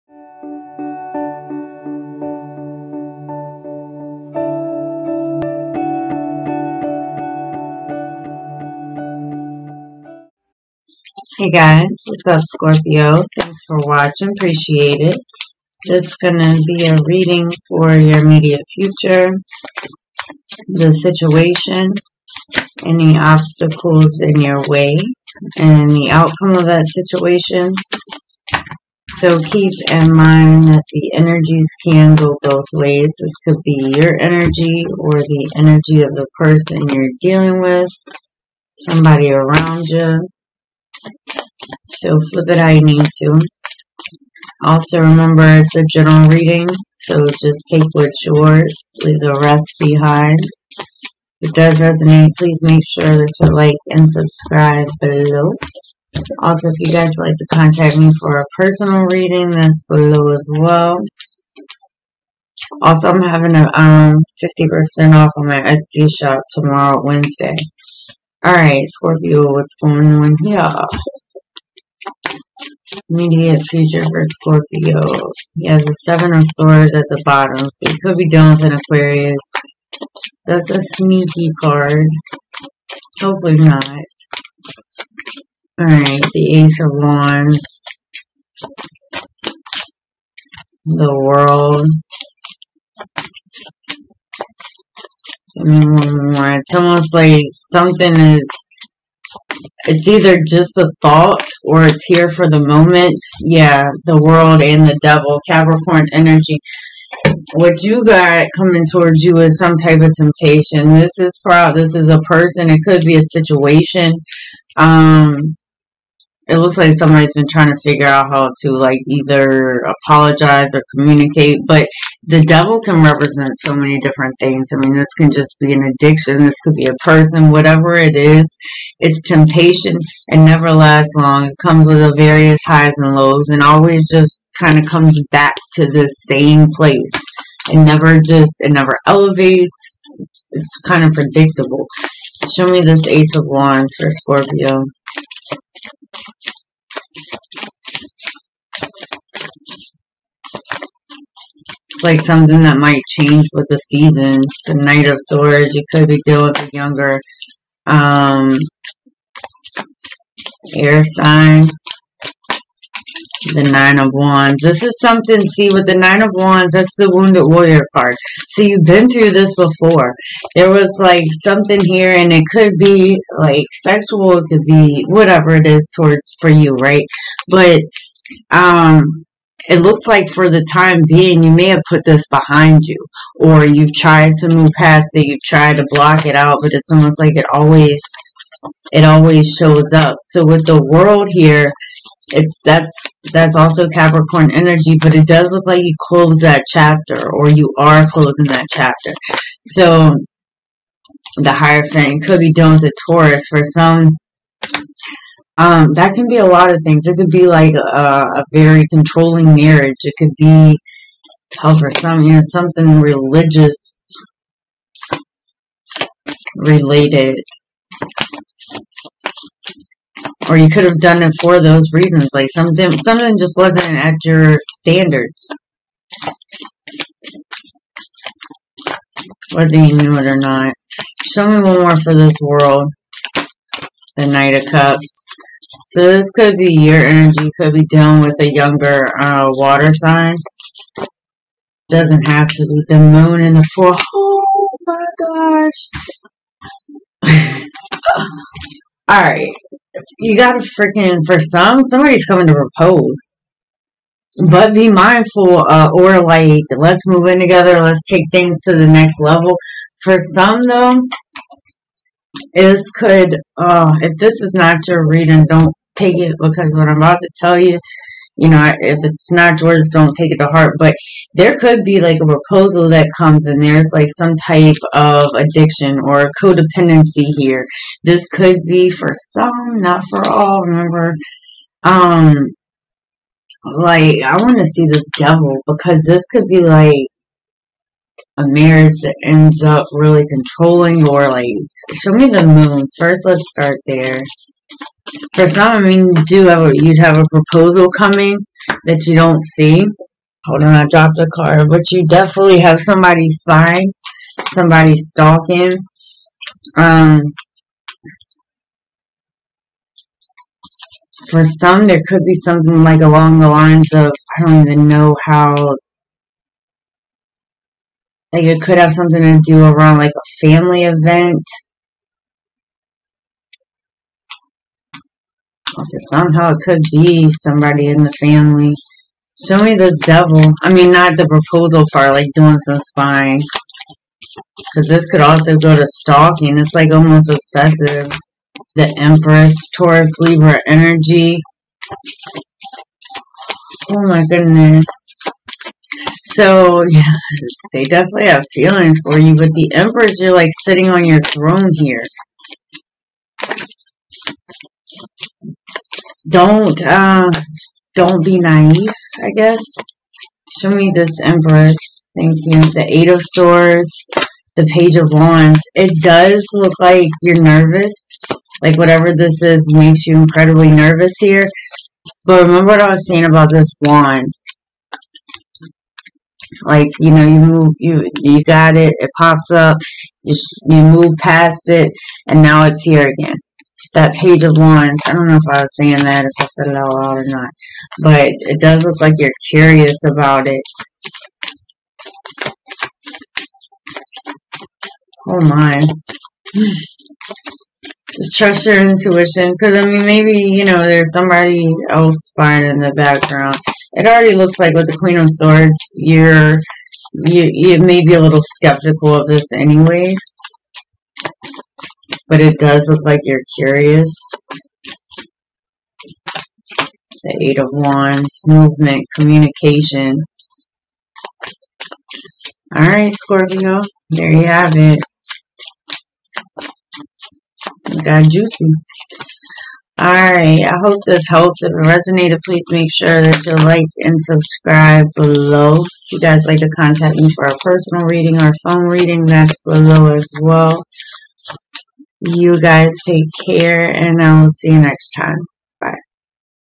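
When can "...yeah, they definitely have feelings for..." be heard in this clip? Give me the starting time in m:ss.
5:46.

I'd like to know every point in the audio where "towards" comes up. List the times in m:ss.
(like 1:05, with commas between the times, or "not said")
1:48, 2:55.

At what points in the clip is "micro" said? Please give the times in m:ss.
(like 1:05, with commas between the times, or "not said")
not said.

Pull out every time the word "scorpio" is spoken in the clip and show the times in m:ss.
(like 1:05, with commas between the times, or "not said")
0:12, 1:08, 1:14, 2:24, 7:03.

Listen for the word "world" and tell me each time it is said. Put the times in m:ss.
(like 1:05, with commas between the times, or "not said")
1:31, 1:44, 3:10, 3:52.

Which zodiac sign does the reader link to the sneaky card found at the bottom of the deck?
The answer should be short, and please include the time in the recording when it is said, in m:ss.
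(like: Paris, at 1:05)
Aquarius, at 1:18.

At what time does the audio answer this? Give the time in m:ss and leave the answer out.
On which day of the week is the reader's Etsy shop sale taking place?
1:07.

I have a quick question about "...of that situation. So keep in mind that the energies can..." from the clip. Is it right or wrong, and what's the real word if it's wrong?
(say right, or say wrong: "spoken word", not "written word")
right.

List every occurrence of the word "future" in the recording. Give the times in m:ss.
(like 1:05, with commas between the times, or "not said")
0:18, 1:13.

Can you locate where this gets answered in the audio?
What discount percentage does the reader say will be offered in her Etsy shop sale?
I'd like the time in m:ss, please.
1:04.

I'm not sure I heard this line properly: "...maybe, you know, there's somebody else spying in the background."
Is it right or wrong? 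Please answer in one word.
right.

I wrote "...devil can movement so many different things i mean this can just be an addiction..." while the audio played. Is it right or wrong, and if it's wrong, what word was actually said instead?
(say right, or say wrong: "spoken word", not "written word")
wrong: "represent", not "movement".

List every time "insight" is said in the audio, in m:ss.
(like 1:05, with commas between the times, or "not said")
not said.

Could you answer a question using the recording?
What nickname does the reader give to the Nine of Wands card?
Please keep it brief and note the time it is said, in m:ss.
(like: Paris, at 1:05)
Wounded Warrior card, at 2:47.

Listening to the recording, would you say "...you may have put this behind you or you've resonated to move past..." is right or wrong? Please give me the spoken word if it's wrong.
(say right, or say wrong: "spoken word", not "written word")
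wrong: "tried", not "resonated".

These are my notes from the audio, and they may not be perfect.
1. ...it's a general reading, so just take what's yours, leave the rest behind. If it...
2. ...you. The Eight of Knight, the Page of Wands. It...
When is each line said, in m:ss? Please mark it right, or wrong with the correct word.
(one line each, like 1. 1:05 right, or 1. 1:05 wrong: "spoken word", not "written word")
1. 0:45 right
2. 6:02 wrong: "Swords", not "Knight".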